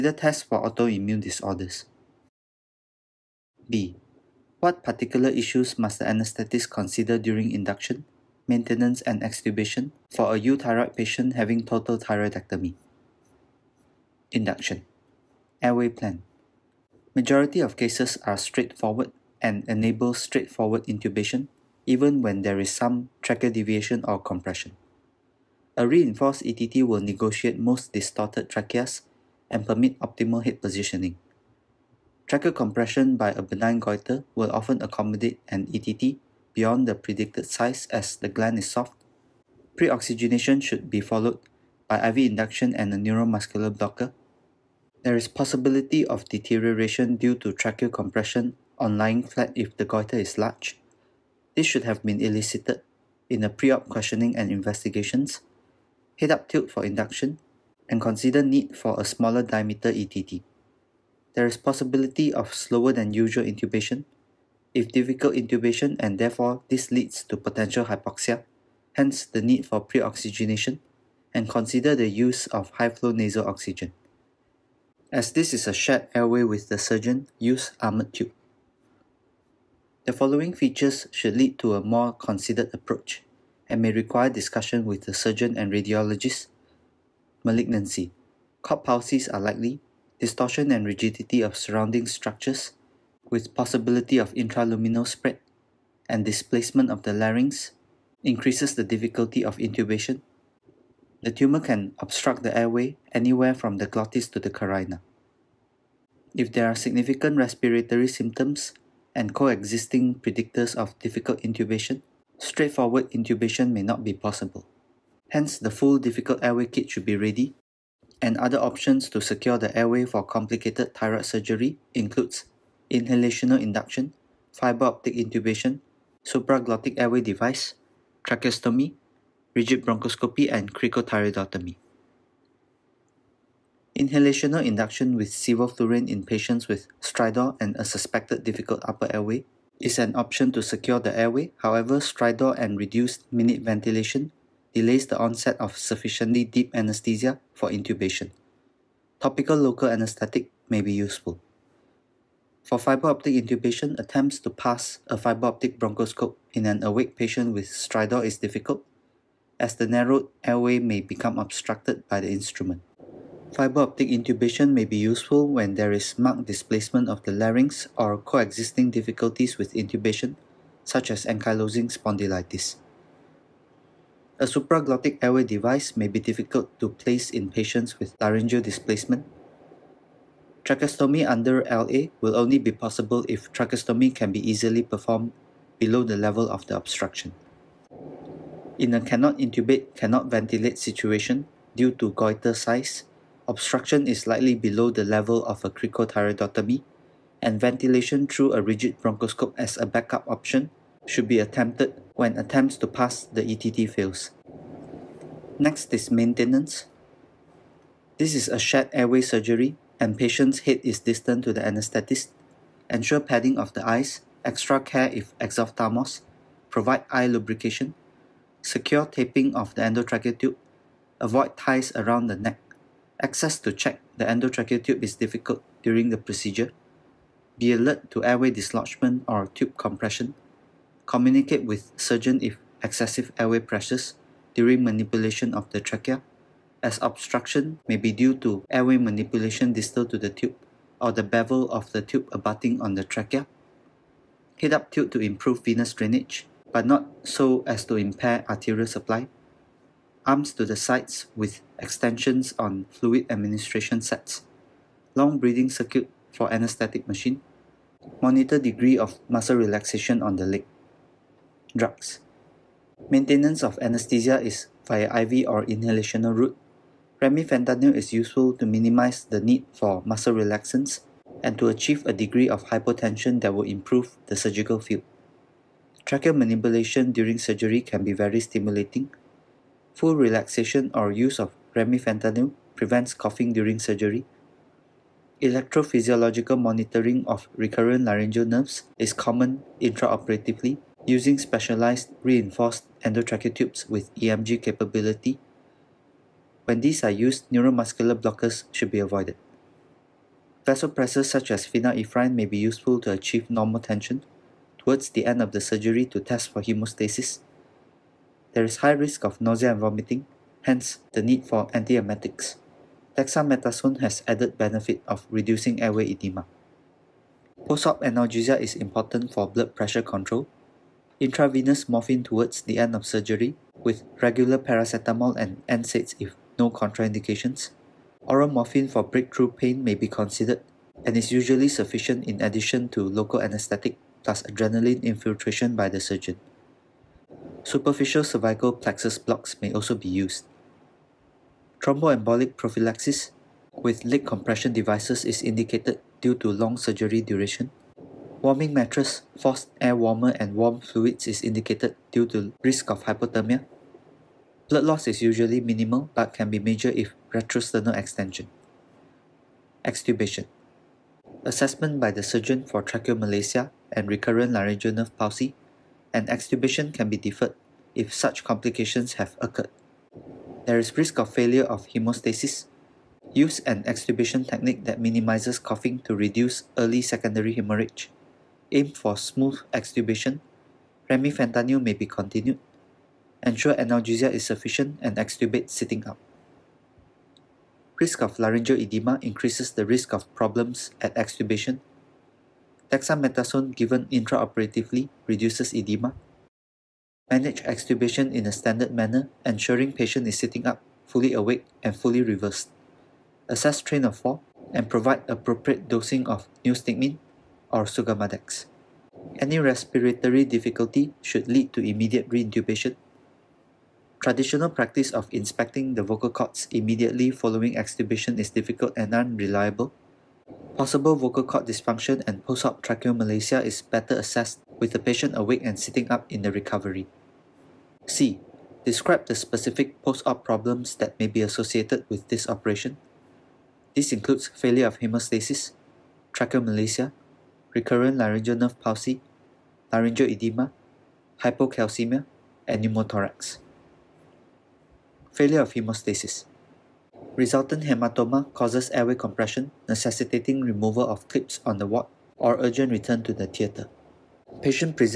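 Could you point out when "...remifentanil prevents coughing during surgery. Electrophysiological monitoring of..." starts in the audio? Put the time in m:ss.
4:41.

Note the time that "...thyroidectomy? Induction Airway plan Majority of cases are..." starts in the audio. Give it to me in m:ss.
0:11.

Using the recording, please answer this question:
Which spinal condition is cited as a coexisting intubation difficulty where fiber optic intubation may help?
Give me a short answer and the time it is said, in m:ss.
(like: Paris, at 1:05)
Ankylosing spondylitis, at 2:51.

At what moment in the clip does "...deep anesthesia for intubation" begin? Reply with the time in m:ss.
2:26.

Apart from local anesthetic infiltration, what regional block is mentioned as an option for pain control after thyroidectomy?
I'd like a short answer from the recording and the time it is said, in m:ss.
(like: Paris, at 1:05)
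Superficial cervical plexus blocks, at 5:37.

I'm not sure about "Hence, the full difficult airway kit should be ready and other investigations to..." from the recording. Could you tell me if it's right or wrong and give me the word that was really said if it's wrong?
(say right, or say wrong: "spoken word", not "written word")
wrong: "options", not "investigations".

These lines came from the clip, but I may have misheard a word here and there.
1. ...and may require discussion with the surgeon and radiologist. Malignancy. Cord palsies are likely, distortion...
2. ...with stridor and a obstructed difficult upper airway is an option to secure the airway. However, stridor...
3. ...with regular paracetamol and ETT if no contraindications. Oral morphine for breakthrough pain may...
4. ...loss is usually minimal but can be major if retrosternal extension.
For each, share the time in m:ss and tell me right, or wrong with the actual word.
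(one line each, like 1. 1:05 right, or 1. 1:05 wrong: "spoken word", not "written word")
1. 1:23 right
2. 2:16 wrong: "suspected", not "obstructed"
3. 5:23 wrong: "NSAIDs", not "ETT"
4. 5:54 right.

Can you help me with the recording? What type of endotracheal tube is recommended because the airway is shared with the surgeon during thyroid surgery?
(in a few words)
Armored tube.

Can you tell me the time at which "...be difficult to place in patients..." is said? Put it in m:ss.
2:56.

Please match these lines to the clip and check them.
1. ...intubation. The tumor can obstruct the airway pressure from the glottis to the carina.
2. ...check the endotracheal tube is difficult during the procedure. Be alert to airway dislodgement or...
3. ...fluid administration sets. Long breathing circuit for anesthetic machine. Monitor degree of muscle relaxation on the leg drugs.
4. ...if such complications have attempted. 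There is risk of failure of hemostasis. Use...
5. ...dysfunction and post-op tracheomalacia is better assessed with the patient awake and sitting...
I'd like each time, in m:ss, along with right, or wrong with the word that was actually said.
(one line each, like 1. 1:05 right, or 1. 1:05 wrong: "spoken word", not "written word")
1. 1:39 wrong: "anywhere", not "pressure"
2. 3:43 right
3. 4:12 right
4. 6:07 wrong: "occurred", not "attempted"
5. 7:01 right.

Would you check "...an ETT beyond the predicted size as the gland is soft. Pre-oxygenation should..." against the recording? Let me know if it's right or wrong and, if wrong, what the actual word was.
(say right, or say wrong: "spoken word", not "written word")
right.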